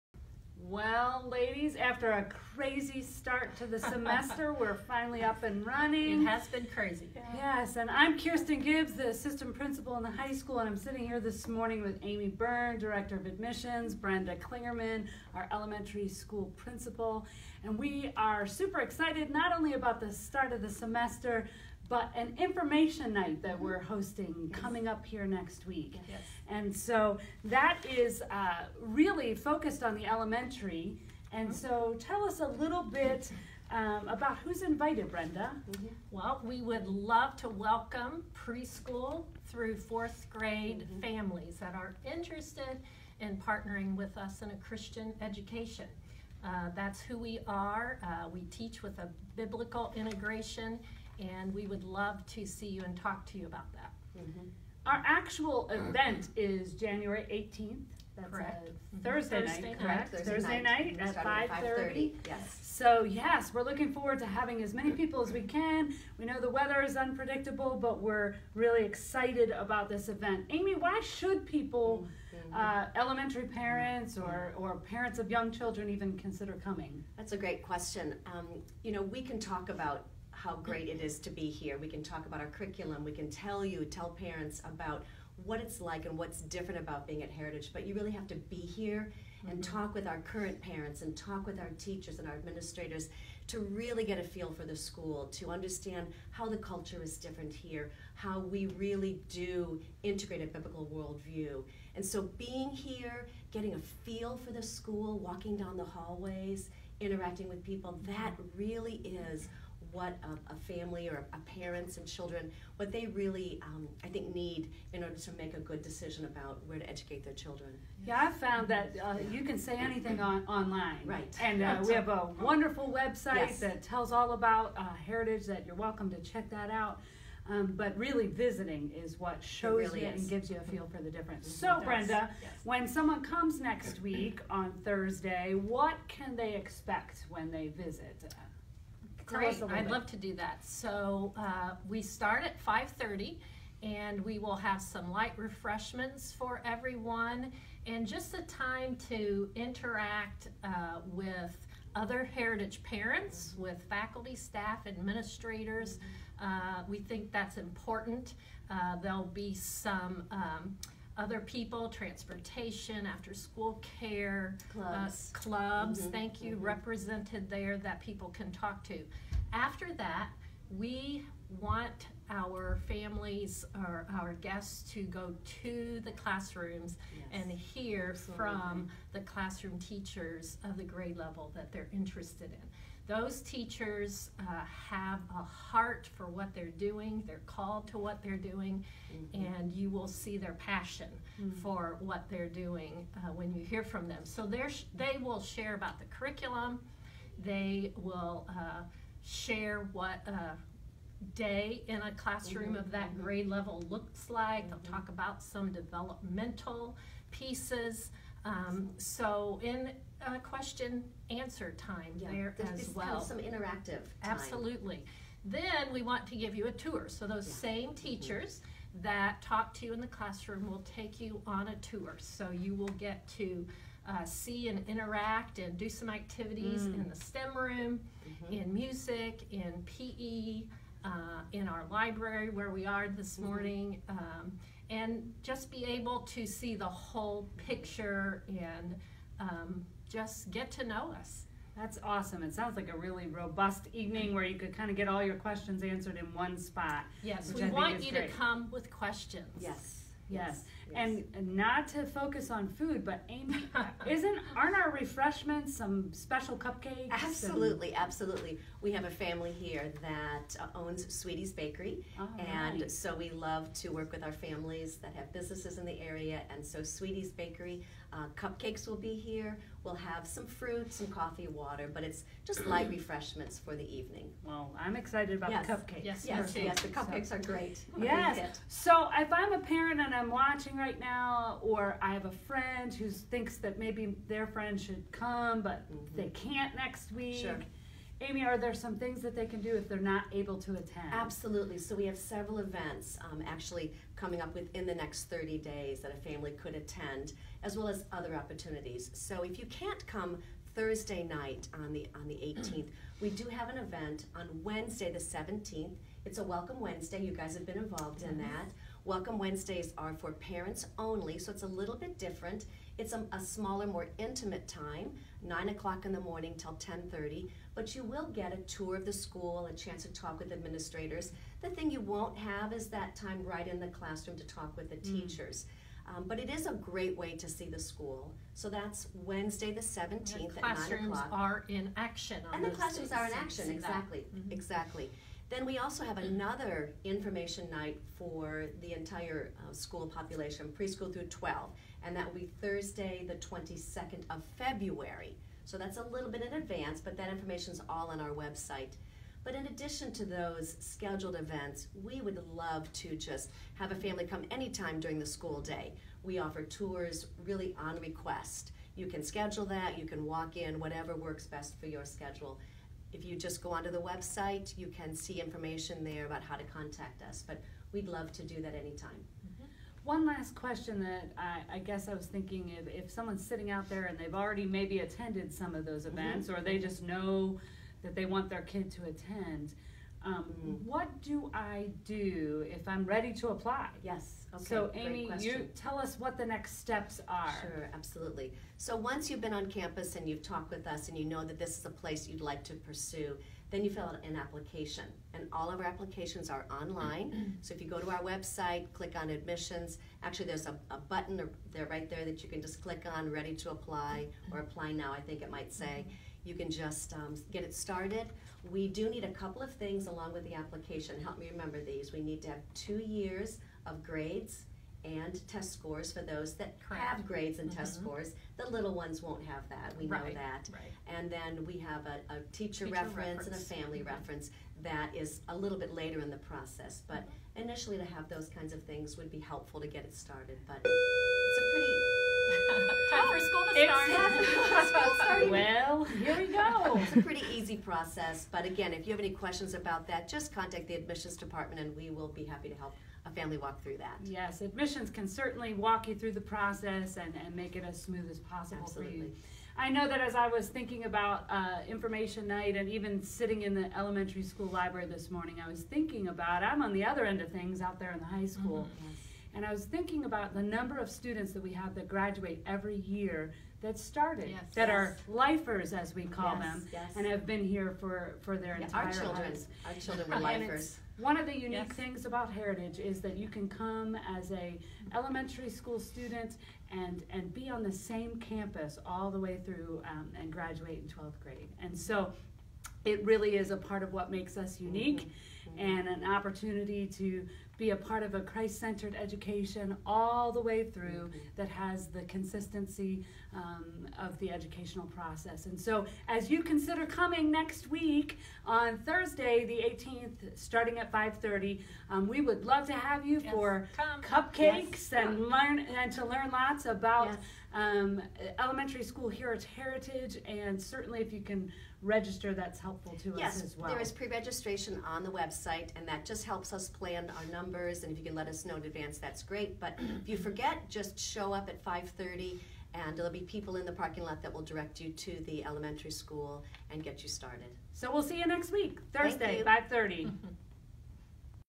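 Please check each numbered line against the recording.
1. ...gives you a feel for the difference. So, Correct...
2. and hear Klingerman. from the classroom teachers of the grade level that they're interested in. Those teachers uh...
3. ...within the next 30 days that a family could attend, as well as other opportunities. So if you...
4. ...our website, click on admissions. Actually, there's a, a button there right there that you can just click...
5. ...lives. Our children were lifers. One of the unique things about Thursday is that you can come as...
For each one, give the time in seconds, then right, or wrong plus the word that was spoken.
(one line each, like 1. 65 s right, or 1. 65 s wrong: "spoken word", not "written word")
1. 130 s wrong: "Brenda", not "Correct"
2. 177 s wrong: "Absolutely", not "Klingerman"
3. 294 s right
4. 398 s right
5. 469 s wrong: "Heritage", not "Thursday".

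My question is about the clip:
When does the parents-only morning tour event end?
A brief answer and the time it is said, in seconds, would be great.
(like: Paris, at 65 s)
10:30, at 316 s.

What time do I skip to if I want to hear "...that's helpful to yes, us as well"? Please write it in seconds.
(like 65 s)
512 s.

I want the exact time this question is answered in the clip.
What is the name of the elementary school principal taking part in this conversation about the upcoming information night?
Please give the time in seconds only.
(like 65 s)
13 s.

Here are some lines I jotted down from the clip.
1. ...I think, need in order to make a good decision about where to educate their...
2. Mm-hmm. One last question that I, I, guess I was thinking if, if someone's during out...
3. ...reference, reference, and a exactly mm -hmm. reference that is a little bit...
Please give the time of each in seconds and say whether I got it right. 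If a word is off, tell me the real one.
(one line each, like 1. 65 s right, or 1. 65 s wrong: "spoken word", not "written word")
1. 114 s right
2. 369 s wrong: "sitting", not "during"
3. 422 s wrong: "family", not "exactly".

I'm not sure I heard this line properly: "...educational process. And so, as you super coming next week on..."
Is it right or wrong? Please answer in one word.
wrong.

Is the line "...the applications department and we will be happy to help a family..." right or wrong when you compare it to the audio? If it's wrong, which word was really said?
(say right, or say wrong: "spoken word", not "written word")
wrong: "admissions", not "applications".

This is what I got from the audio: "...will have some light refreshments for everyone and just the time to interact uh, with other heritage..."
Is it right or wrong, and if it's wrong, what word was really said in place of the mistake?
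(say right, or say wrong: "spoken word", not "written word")
right.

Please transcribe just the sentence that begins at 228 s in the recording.
in music, in PE, uh, in our library where we are this mm-hmm.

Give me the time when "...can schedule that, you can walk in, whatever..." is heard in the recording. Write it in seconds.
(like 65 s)
359 s.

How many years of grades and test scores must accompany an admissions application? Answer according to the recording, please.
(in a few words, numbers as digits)
2.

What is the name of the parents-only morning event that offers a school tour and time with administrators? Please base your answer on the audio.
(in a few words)
Welcome Wednesday.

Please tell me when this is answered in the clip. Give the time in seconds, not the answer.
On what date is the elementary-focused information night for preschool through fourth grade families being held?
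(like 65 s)
56 s.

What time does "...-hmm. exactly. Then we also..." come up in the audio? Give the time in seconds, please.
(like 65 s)
334 s.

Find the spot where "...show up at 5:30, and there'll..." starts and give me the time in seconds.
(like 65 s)
521 s.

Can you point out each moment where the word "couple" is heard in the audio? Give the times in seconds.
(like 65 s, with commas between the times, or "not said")
409 s.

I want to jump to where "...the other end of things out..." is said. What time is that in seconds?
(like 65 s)
456 s.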